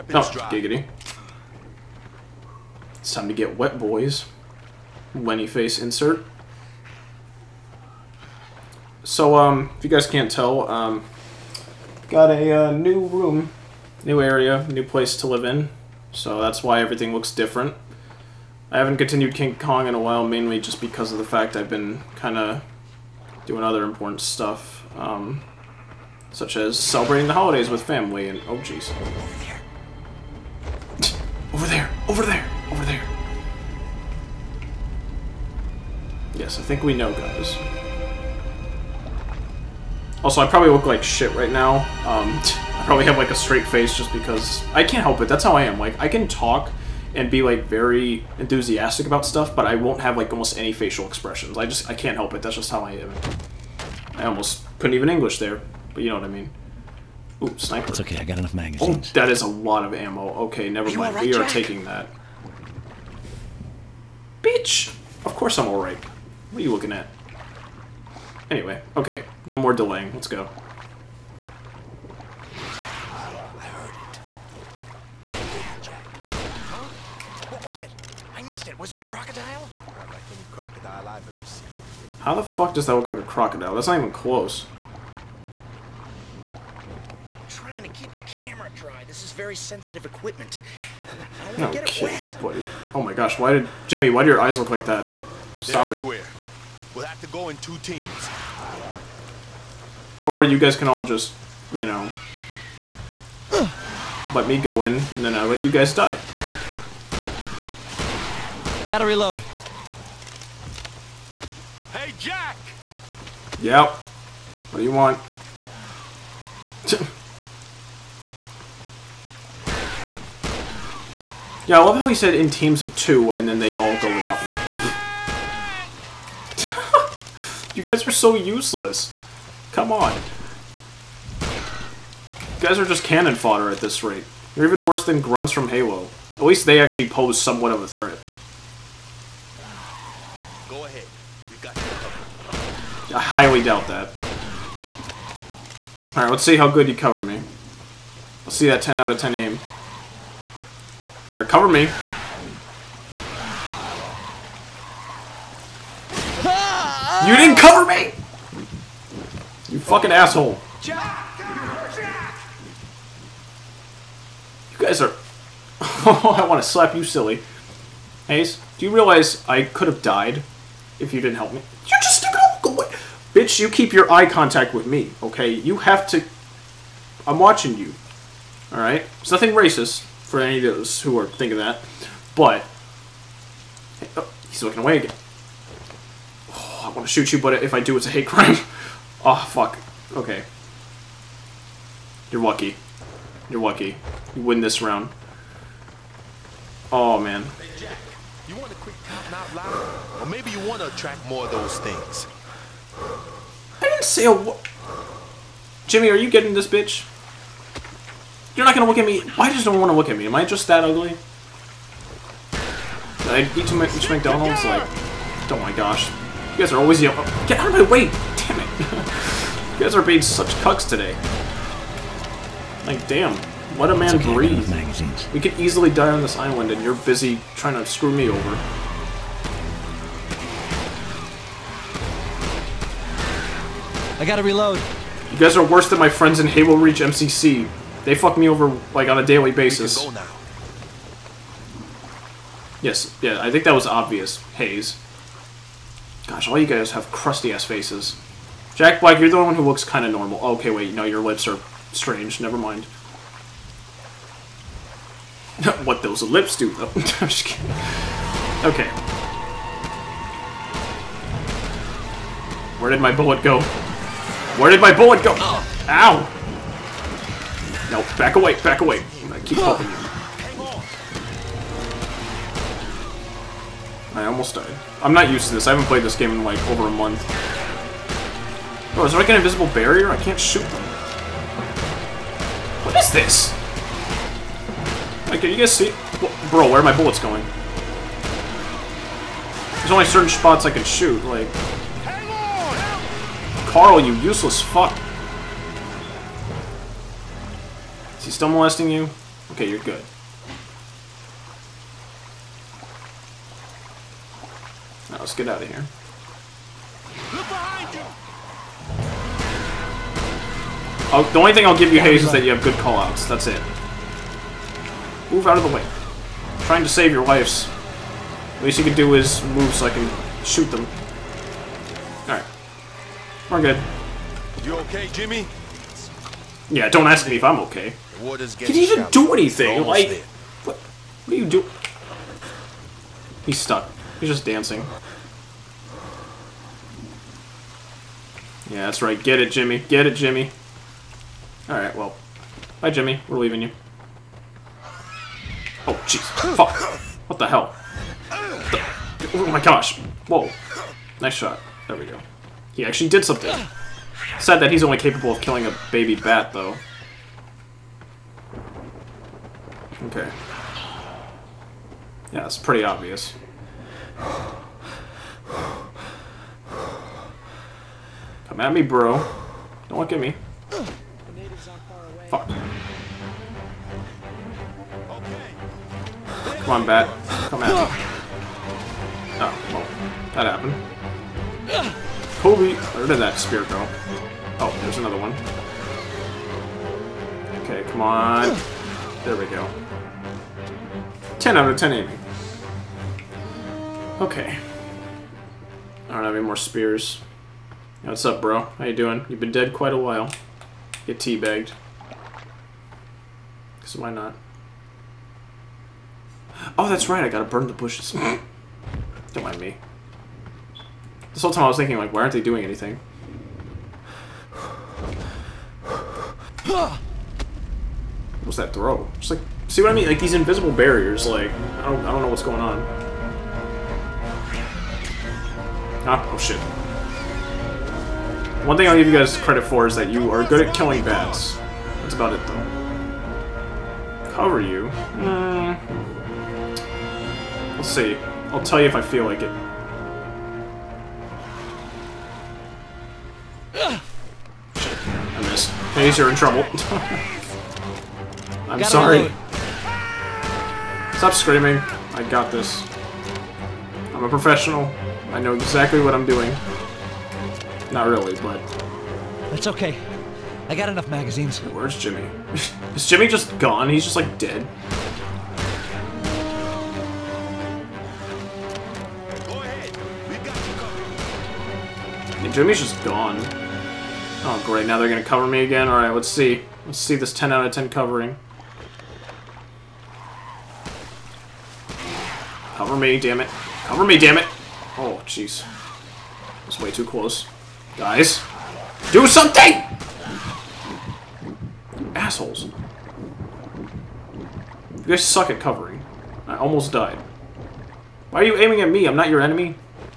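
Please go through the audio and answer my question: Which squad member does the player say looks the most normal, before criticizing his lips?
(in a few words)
Jack Black.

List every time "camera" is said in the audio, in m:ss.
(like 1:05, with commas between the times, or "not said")
1:28.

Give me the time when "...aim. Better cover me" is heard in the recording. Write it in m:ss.
2:29.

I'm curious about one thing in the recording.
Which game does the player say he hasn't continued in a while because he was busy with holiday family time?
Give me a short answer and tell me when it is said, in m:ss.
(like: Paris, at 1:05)
King Kong, at 0:19.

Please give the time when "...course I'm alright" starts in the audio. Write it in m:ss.
1:05.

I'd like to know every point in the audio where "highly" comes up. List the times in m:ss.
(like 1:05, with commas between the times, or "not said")
2:23.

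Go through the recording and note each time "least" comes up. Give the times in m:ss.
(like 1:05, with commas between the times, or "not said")
2:16, 5:18.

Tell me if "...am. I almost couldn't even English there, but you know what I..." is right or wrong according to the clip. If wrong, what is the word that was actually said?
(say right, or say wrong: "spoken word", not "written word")
right.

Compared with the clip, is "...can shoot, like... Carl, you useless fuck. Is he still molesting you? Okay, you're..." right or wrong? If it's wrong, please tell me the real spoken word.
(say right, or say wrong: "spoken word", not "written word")
right.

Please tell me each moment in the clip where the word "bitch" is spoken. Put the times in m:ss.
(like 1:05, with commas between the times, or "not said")
1:04, 2:53, 3:26.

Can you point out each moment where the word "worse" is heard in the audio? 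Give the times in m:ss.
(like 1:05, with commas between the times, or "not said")
2:14, 3:55.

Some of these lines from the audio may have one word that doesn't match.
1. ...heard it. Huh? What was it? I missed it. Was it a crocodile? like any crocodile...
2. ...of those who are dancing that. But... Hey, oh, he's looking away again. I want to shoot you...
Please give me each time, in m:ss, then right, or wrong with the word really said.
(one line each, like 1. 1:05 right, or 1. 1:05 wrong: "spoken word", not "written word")
1. 1:13 right
2. 3:00 wrong: "thinking", not "dancing".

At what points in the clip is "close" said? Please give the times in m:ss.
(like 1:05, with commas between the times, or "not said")
1:24, 8:07.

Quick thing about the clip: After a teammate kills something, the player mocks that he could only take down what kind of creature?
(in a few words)
a baby bat.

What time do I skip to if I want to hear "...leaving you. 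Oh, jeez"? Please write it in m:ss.
5:43.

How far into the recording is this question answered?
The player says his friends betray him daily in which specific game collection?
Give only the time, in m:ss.
3:56.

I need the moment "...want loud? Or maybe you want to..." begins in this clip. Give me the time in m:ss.
3:18.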